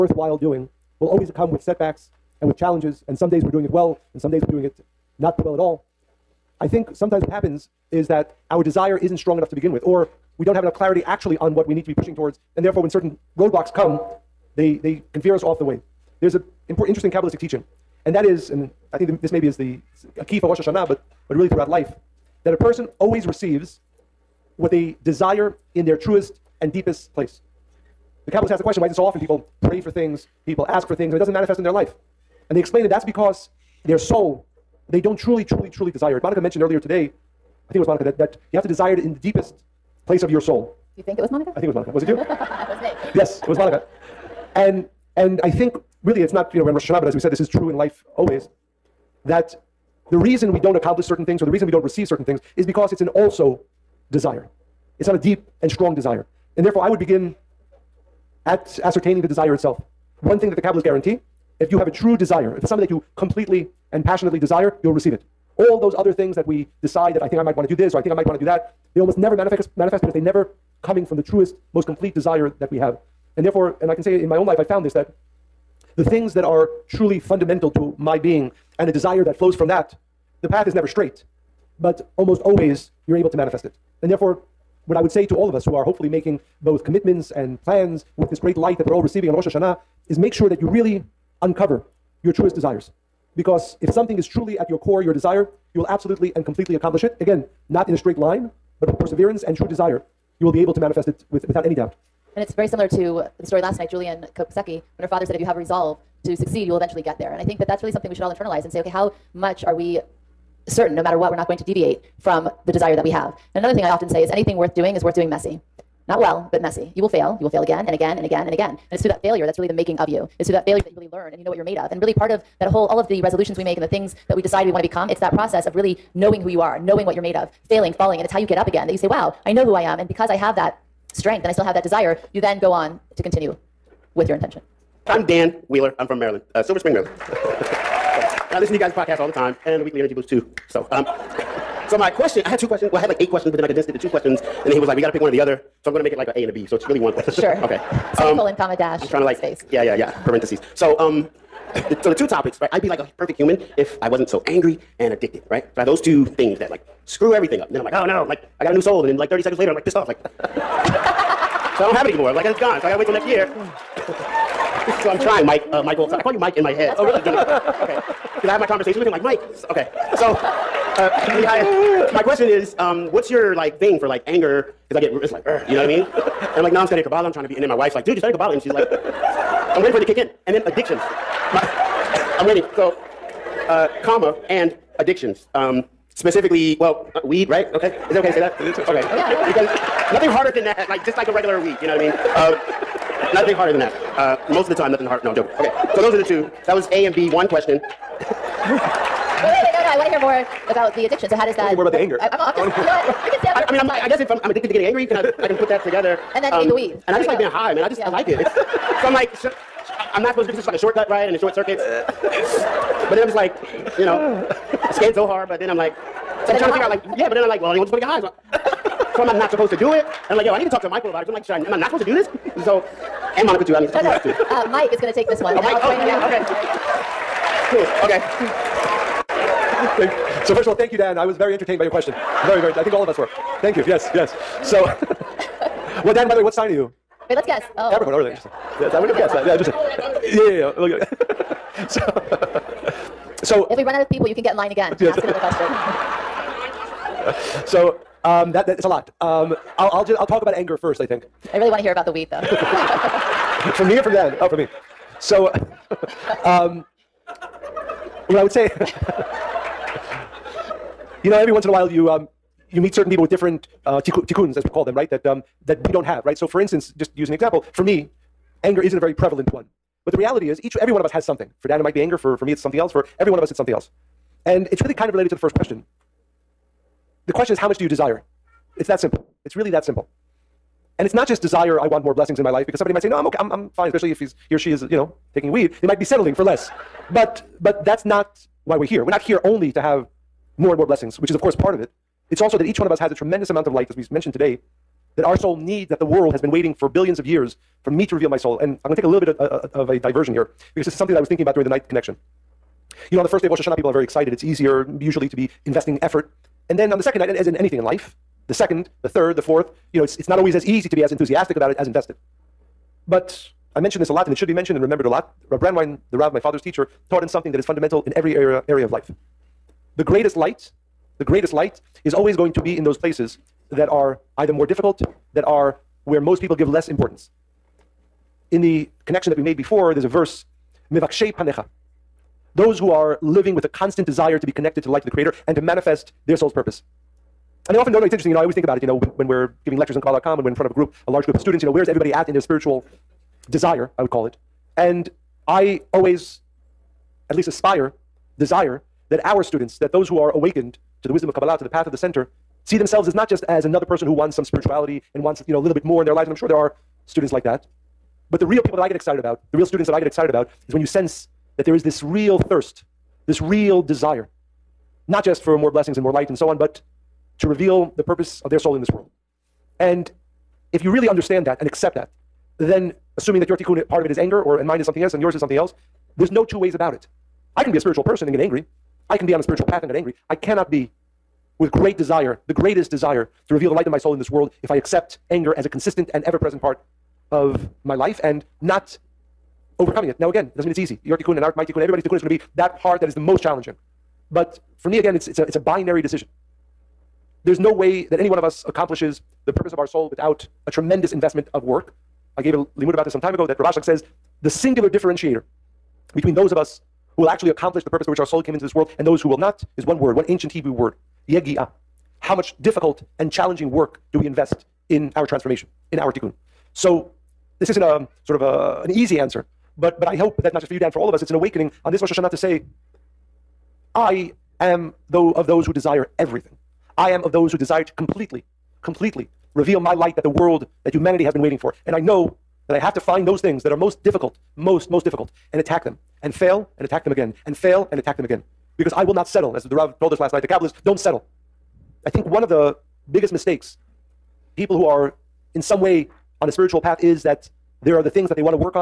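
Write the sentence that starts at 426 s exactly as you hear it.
I am of those who desire to completely, completely reveal my light that the world that humanity has been waiting for.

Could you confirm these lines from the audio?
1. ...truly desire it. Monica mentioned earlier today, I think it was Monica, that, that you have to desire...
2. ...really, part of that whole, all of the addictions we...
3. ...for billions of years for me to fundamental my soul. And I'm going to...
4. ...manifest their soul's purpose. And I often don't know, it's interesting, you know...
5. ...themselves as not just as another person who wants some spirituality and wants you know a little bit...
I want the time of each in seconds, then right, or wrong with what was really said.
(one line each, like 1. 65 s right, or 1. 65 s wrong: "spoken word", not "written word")
1. 35 s right
2. 122 s wrong: "resolutions", not "addictions"
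3. 296 s wrong: "reveal", not "fundamental"
4. 335 s right
5. 352 s right.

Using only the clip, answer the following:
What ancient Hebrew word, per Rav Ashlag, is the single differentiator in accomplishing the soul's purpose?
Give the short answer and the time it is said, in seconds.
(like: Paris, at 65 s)
yegi'ah, at 411 s.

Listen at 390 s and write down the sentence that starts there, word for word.
Now, again, it doesn't mean it's easy.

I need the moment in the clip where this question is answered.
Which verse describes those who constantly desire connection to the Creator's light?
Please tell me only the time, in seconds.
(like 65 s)
330 s.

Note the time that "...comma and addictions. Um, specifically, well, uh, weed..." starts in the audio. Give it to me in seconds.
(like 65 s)
184 s.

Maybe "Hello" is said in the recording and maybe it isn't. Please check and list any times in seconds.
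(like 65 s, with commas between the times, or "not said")
not said.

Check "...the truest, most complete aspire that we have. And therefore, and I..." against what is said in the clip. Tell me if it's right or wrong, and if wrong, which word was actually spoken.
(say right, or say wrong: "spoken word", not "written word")
wrong: "desire", not "aspire".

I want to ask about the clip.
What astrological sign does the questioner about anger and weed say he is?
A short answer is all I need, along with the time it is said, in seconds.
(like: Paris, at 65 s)
Capricorn, at 237 s.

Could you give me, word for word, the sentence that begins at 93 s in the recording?
Because if something is truly at your core, your desire, you will absolutely and completely accomplish it.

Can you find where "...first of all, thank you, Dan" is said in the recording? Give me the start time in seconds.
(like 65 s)
230 s.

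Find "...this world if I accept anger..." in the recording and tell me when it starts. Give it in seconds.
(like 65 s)
384 s.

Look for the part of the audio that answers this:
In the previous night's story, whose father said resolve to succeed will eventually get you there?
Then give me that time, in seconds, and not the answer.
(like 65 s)
103 s.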